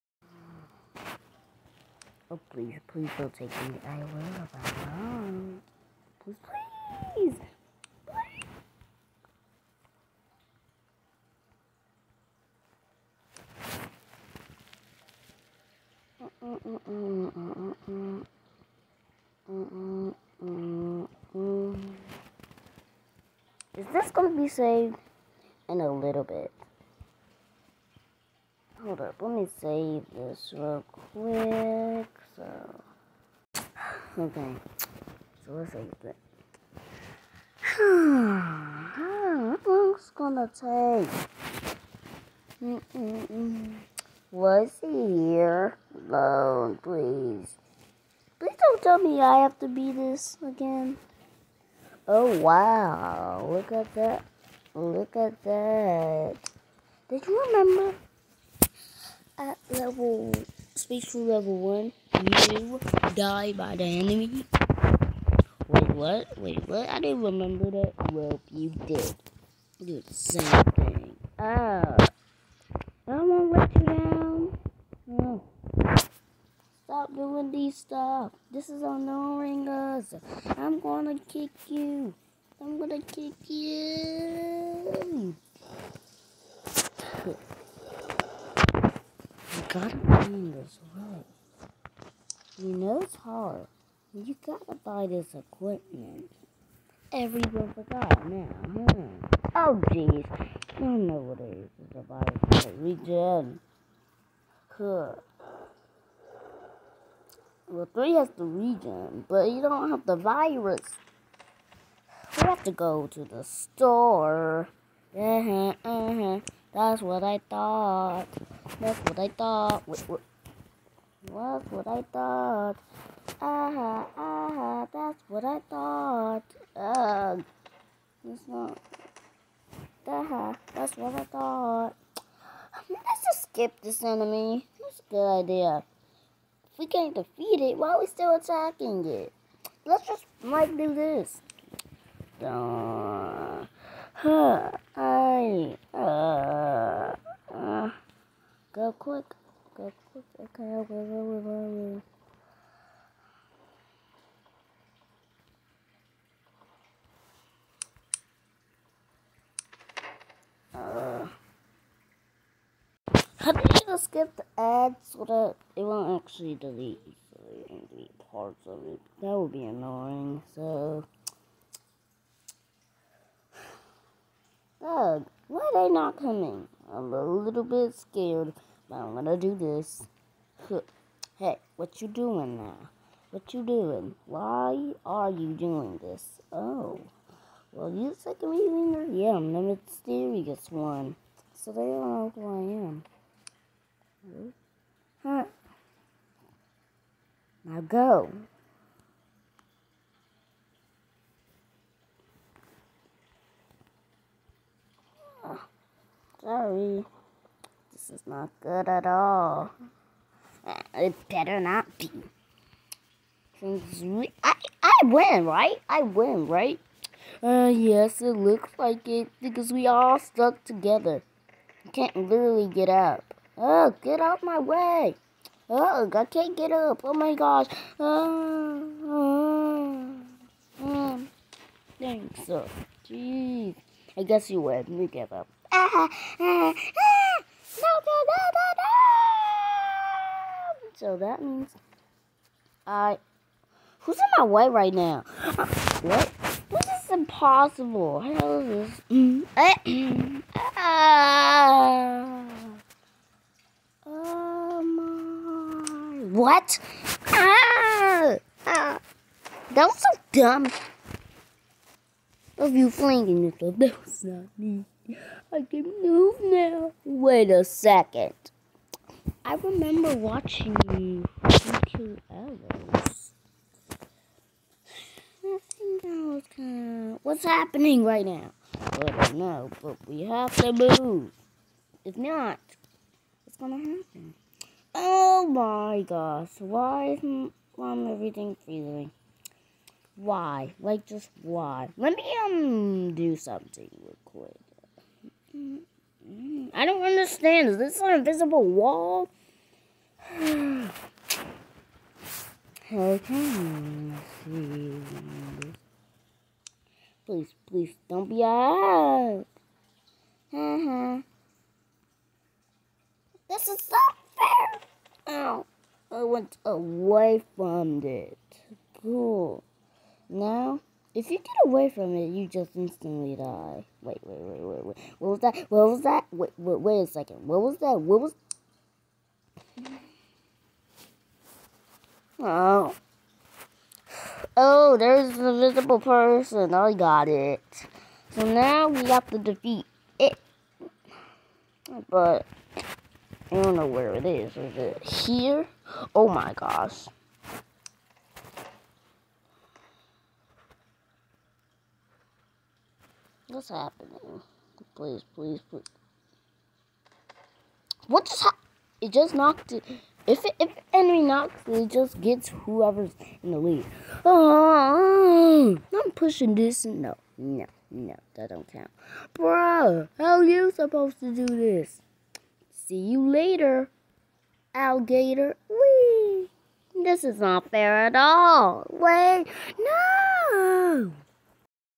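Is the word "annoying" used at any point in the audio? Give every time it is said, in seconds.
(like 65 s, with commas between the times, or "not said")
78 s, 169 s.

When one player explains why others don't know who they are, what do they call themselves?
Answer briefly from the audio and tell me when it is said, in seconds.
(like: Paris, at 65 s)
the mysterious one, at 189 s.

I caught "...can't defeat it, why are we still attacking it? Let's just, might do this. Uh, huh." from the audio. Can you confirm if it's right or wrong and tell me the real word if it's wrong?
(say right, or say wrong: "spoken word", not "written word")
right.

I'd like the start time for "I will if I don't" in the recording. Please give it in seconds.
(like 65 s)
3 s.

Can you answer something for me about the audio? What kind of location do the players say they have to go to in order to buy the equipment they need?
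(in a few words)
the store.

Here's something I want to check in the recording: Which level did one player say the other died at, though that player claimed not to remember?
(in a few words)
Spacecrew level 1.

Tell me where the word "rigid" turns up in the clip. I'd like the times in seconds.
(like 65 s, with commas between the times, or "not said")
not said.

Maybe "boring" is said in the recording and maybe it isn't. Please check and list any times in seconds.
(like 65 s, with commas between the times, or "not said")
not said.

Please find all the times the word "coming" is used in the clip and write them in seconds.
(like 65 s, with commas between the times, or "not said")
176 s.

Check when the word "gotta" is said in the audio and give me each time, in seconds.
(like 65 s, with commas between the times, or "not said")
89 s, 94 s.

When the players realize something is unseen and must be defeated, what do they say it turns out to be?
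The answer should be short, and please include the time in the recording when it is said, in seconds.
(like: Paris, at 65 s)
an invisible person, at 335 s.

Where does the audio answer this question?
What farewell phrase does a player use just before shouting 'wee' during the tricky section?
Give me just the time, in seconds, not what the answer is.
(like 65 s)
372 s.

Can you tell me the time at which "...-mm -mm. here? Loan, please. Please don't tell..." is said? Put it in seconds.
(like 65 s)
42 s.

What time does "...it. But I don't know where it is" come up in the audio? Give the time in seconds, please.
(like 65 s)
340 s.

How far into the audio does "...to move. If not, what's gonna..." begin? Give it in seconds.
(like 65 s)
280 s.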